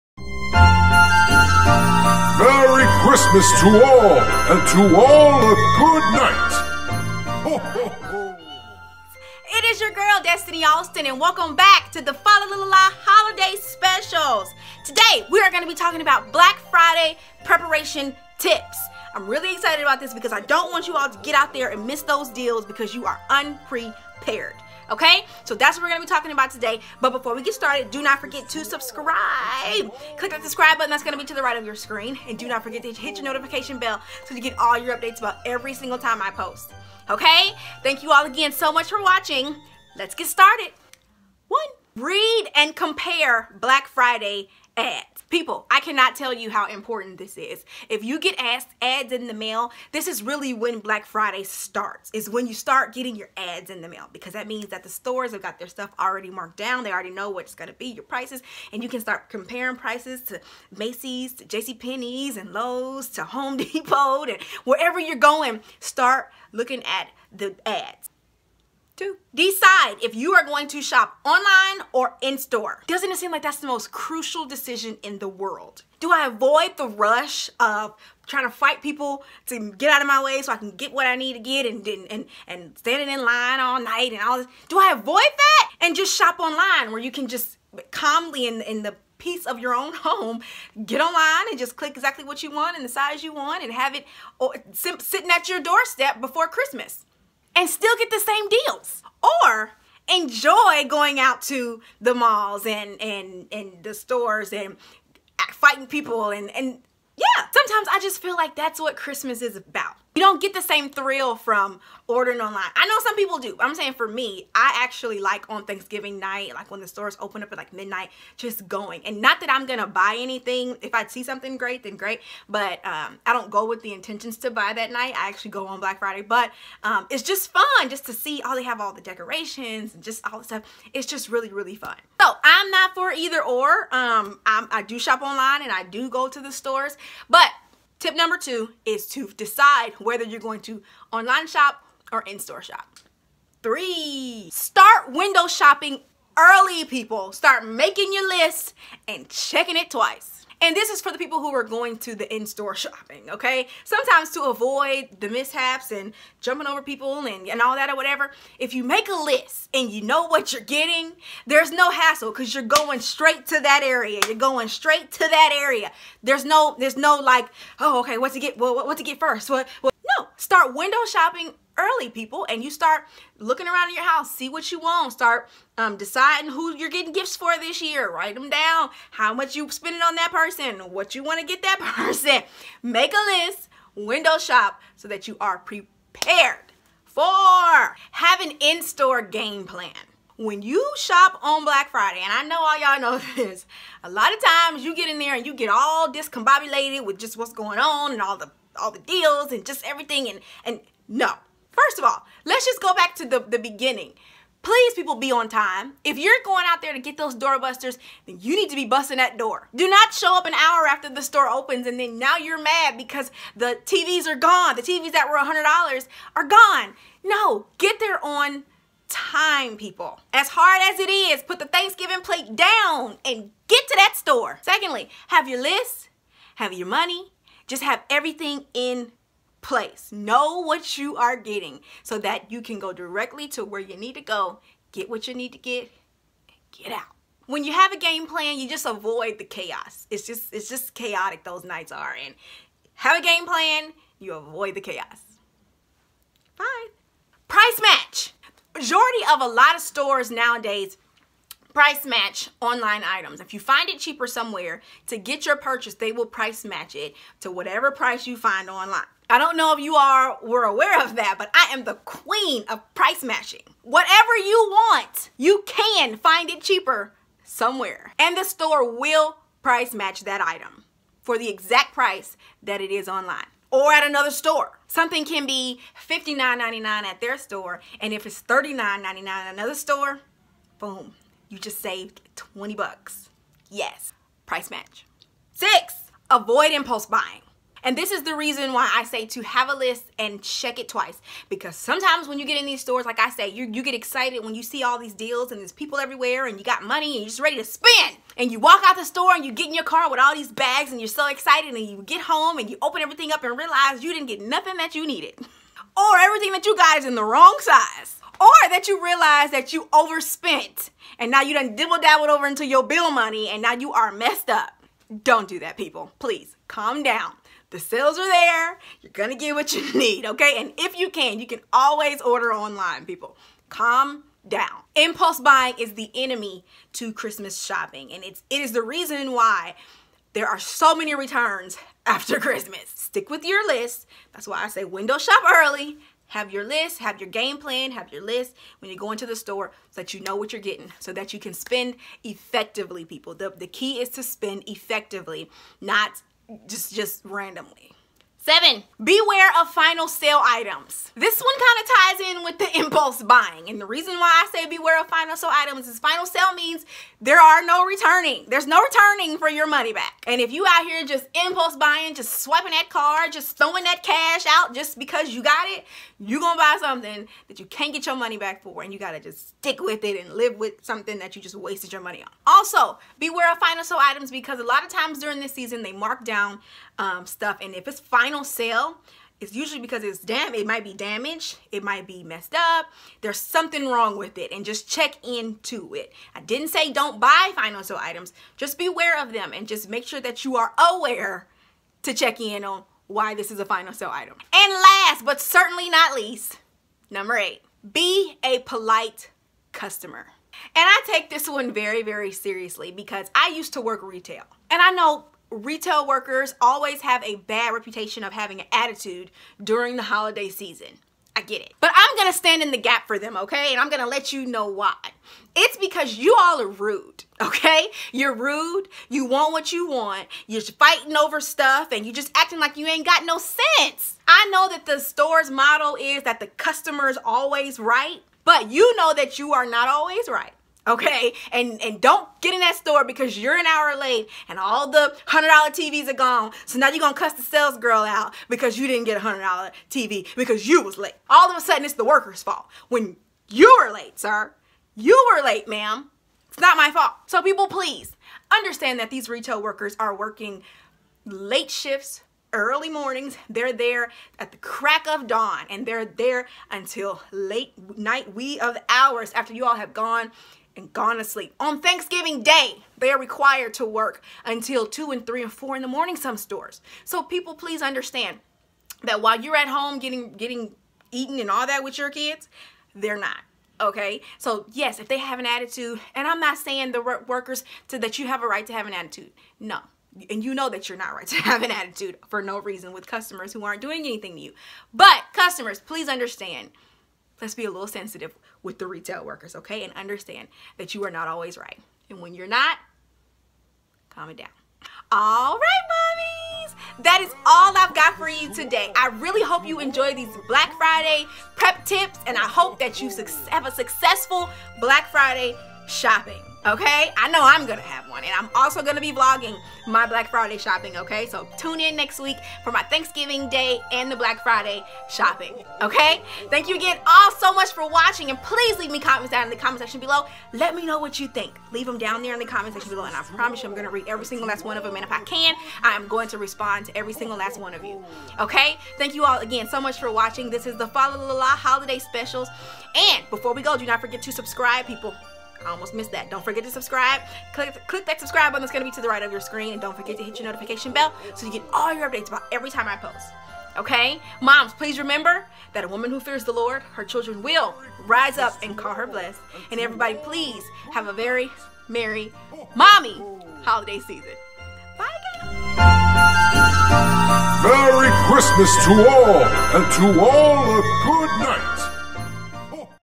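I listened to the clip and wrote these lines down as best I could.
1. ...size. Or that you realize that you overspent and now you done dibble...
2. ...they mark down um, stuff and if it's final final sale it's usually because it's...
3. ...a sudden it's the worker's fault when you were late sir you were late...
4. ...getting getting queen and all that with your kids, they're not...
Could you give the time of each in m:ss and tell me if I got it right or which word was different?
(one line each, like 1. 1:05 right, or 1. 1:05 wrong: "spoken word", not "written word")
1. 5:07 right
2. 6:15 right
3. 7:21 right
4. 7:49 wrong: "eaten", not "queen".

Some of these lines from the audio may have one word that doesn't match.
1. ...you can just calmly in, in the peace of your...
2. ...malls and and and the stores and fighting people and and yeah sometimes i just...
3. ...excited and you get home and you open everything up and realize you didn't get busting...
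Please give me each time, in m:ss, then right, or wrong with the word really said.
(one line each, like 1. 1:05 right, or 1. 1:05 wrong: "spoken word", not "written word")
1. 1:27 right
2. 1:42 right
3. 5:01 wrong: "nothing", not "busting".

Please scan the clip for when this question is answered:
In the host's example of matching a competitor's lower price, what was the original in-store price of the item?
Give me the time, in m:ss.
4:36.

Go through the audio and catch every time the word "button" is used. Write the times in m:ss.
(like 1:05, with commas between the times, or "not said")
0:30, 8:58.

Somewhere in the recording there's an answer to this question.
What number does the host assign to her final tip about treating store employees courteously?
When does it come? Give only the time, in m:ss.
6:37.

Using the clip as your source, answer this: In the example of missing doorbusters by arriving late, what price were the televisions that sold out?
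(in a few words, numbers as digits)
$100.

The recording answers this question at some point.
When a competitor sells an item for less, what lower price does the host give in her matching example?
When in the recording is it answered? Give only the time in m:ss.
4:38.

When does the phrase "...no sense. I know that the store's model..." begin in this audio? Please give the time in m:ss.
7:03.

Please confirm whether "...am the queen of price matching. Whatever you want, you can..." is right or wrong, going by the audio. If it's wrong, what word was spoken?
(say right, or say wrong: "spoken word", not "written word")
right.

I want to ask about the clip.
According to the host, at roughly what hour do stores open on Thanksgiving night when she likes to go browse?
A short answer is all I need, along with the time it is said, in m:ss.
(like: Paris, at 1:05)
midnight, at 1:57.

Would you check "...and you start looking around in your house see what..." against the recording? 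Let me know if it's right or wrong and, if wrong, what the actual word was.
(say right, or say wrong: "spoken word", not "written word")
right.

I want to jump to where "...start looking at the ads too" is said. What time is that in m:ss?
1:05.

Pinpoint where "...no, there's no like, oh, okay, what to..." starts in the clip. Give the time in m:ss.
2:46.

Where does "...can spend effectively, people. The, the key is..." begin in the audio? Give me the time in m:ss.
5:41.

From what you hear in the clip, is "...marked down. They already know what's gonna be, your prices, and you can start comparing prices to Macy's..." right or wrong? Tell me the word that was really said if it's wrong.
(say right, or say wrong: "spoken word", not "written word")
right.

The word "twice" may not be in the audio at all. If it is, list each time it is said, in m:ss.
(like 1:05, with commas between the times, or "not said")
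2:29, 4:50.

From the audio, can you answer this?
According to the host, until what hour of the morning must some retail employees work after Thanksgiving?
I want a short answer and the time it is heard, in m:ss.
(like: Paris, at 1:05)
4, at 7:45.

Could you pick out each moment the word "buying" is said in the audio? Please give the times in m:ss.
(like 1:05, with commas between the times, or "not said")
4:47, 5:25, 5:53, 6:01.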